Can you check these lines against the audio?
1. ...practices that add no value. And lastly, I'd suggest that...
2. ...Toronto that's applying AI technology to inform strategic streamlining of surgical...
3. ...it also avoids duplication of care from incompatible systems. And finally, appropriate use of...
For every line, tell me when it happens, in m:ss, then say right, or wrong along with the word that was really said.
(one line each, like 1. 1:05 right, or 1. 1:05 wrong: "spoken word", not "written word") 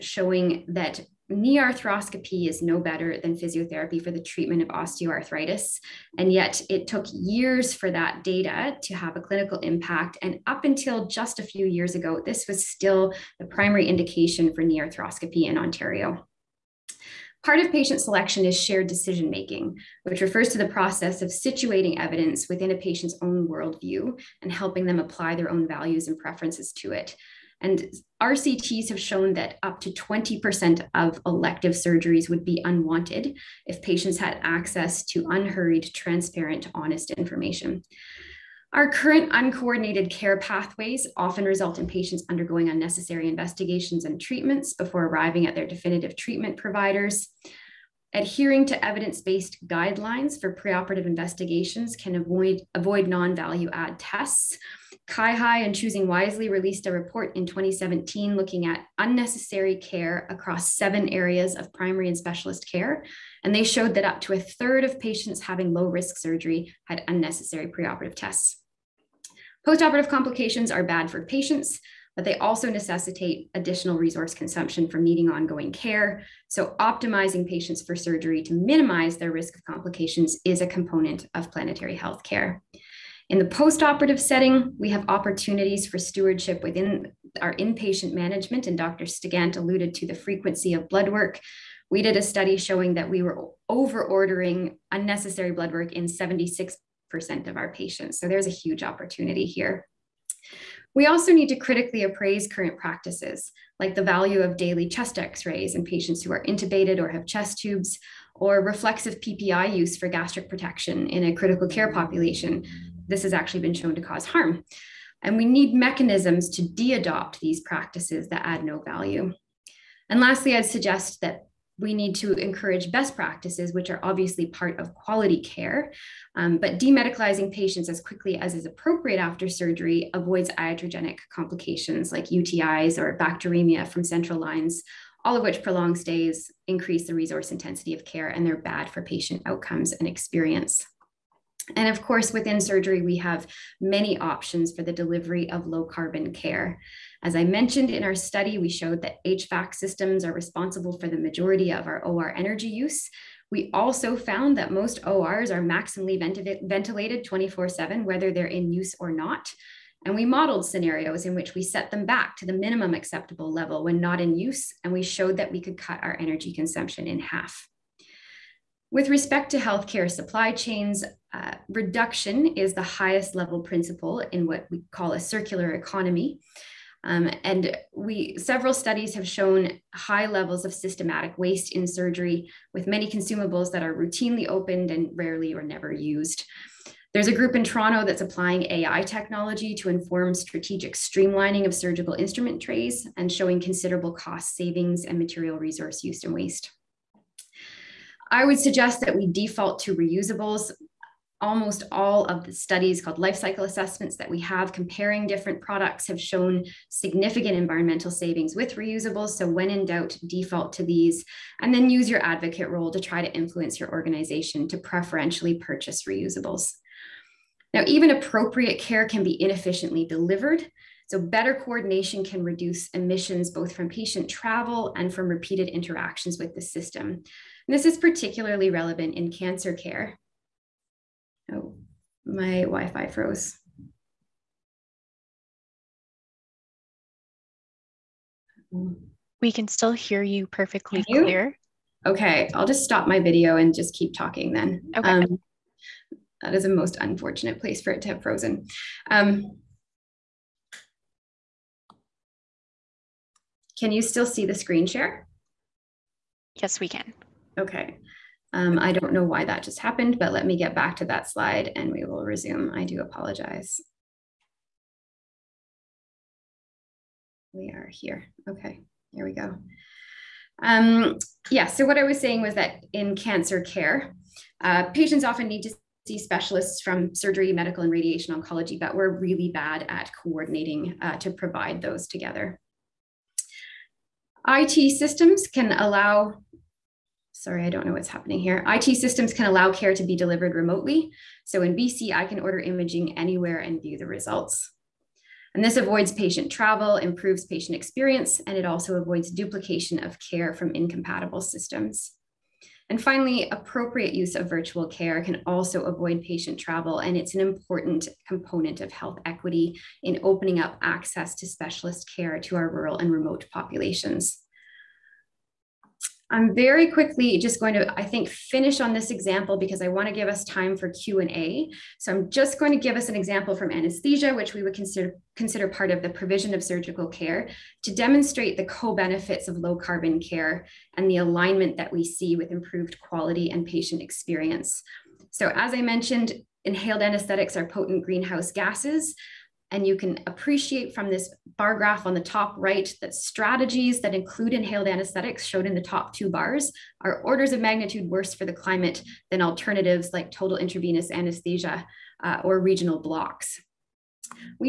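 1. 1:57 right
2. 3:07 right
3. 4:58 right.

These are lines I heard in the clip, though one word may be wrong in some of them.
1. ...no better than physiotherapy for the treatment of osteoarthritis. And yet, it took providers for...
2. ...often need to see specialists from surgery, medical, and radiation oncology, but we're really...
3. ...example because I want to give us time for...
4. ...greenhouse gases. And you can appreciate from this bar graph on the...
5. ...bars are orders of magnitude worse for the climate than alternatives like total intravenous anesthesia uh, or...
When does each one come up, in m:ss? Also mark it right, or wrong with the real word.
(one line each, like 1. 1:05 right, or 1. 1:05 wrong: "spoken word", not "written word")
1. 0:02 wrong: "years", not "providers"
2. 4:35 right
3. 5:19 right
4. 5:38 right
5. 5:46 right.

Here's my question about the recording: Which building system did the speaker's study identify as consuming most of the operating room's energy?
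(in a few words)
HVAC systems.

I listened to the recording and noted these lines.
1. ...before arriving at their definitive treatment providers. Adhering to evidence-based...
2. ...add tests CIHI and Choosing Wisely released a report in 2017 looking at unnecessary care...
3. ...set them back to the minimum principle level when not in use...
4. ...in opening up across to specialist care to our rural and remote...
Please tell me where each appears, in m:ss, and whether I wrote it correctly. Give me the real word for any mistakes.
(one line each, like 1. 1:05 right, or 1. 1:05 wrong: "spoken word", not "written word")
1. 0:44 right
2. 0:53 right
3. 2:41 wrong: "acceptable", not "principle"
4. 5:10 wrong: "access", not "across".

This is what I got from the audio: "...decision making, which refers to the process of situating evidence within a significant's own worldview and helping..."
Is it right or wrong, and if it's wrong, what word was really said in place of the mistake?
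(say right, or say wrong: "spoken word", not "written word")
wrong: "patient", not "significant".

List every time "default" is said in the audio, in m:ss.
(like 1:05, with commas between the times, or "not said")
3:19, 3:30.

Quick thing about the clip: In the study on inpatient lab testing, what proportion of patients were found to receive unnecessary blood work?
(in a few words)
76%.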